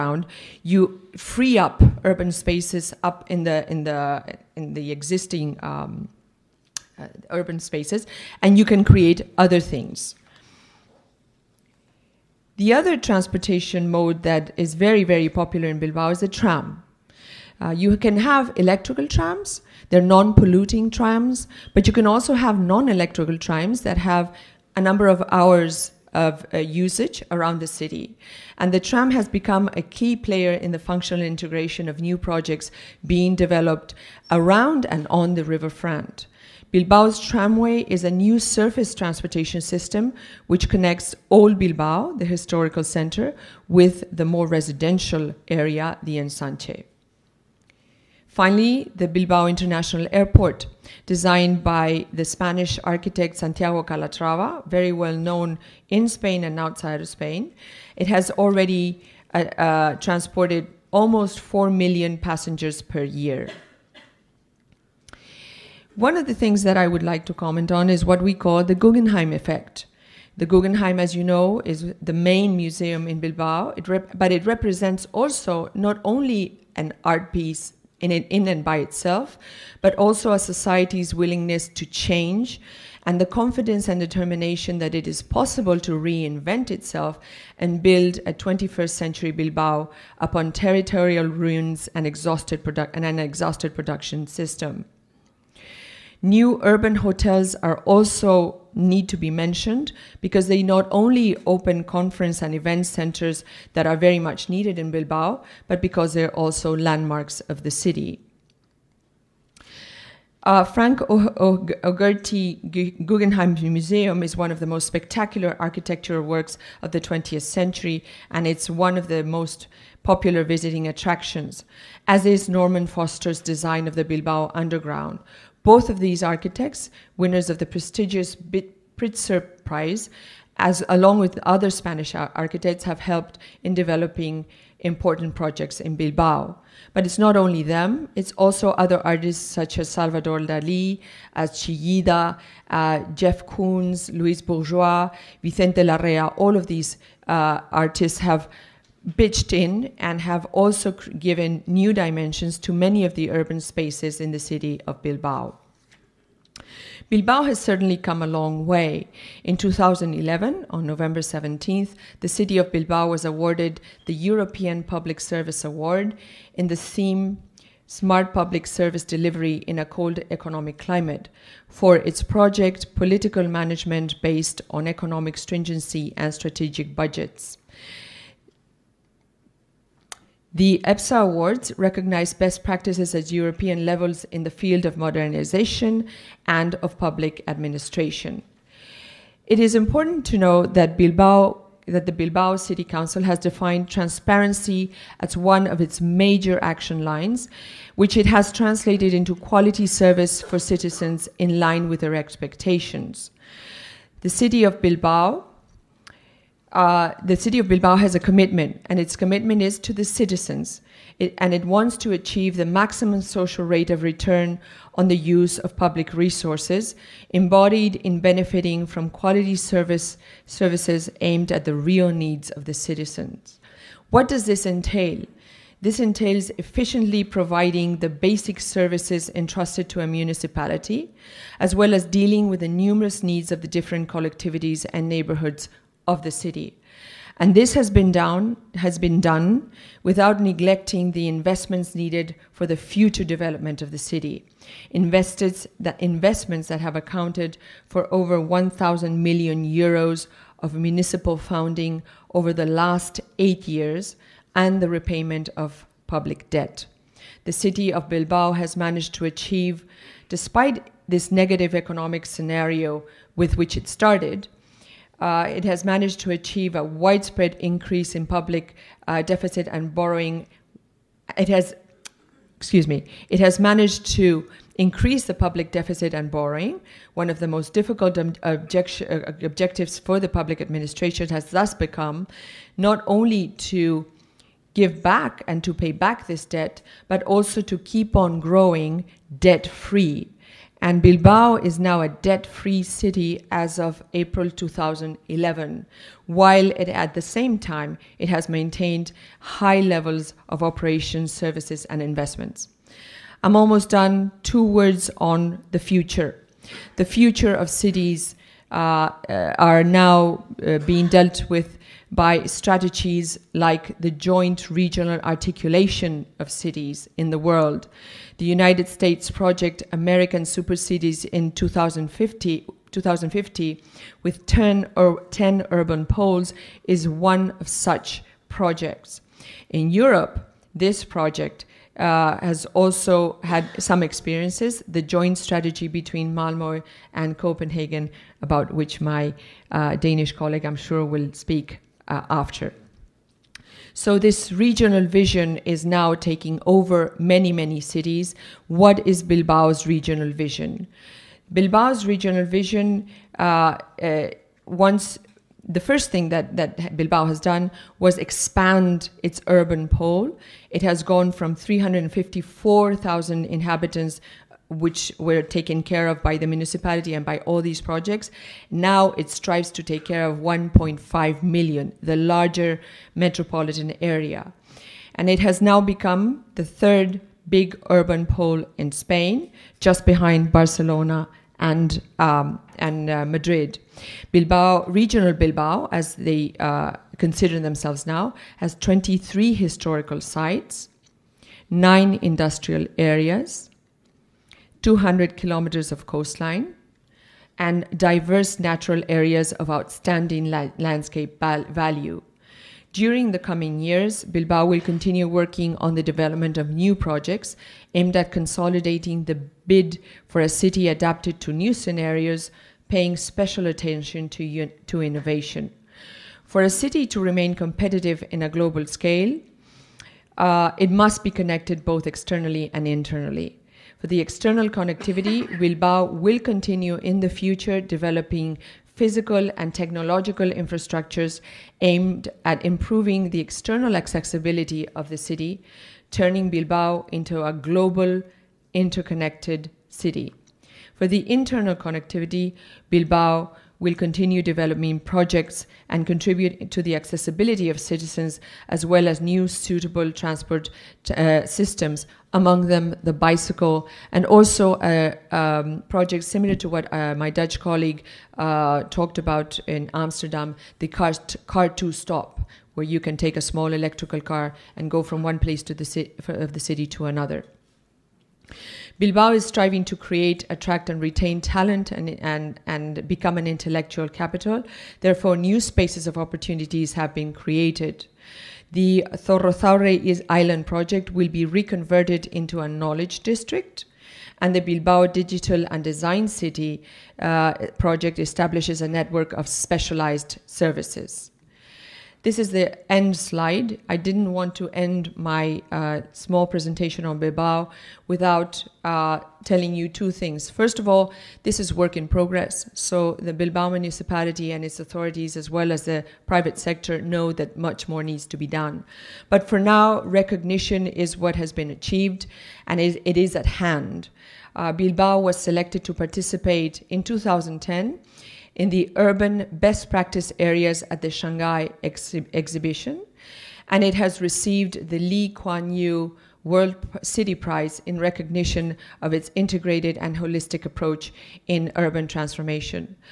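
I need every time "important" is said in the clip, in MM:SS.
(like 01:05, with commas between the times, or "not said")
02:14, 03:09.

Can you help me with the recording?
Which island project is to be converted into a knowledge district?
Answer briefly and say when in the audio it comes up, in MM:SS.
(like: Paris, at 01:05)
Zorrozaurre Island, at 07:59.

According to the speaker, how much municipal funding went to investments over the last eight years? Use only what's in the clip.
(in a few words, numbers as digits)
over 1,000 million euros.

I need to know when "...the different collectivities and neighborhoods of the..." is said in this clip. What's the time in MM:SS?
03:53.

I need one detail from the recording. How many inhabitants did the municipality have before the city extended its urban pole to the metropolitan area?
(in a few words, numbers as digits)
354,000.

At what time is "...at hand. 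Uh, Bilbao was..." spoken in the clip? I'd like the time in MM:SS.
08:33.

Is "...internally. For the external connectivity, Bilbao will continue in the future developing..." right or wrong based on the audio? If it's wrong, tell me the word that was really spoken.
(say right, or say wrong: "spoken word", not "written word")
right.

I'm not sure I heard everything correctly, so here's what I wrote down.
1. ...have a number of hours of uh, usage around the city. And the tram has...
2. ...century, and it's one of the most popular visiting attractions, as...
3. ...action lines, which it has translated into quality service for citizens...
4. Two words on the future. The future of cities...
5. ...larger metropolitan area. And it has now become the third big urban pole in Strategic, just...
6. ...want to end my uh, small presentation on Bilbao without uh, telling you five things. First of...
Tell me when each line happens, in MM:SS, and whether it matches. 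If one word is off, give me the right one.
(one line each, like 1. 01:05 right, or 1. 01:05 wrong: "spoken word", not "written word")
1. 00:23 right
2. 01:57 right
3. 03:16 right
4. 05:04 right
5. 06:12 wrong: "Spain", not "Strategic"
6. 08:14 wrong: "two", not "five".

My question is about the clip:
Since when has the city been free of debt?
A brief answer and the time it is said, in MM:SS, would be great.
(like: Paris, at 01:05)
April 2011, at 04:54.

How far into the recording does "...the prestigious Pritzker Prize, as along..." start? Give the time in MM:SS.
02:07.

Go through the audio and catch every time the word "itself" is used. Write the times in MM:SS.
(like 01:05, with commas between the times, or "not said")
01:18, 01:26.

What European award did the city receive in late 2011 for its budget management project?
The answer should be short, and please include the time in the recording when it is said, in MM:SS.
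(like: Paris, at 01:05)
European Public Service Award, at 02:44.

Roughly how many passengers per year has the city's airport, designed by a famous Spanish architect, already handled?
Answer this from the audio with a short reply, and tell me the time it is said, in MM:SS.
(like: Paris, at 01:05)
almost 4 million, at 01:00.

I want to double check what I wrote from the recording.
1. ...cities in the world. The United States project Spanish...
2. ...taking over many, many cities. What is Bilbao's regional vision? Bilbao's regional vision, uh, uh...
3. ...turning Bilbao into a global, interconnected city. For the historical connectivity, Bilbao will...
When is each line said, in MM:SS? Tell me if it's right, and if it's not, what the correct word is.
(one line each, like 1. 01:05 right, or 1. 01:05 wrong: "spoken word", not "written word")
1. 05:16 wrong: "American", not "Spanish"
2. 05:46 right
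3. 07:16 wrong: "internal", not "historical".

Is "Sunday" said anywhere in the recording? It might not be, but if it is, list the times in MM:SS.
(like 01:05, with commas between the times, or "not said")
not said.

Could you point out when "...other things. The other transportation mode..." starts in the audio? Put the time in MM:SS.
00:09.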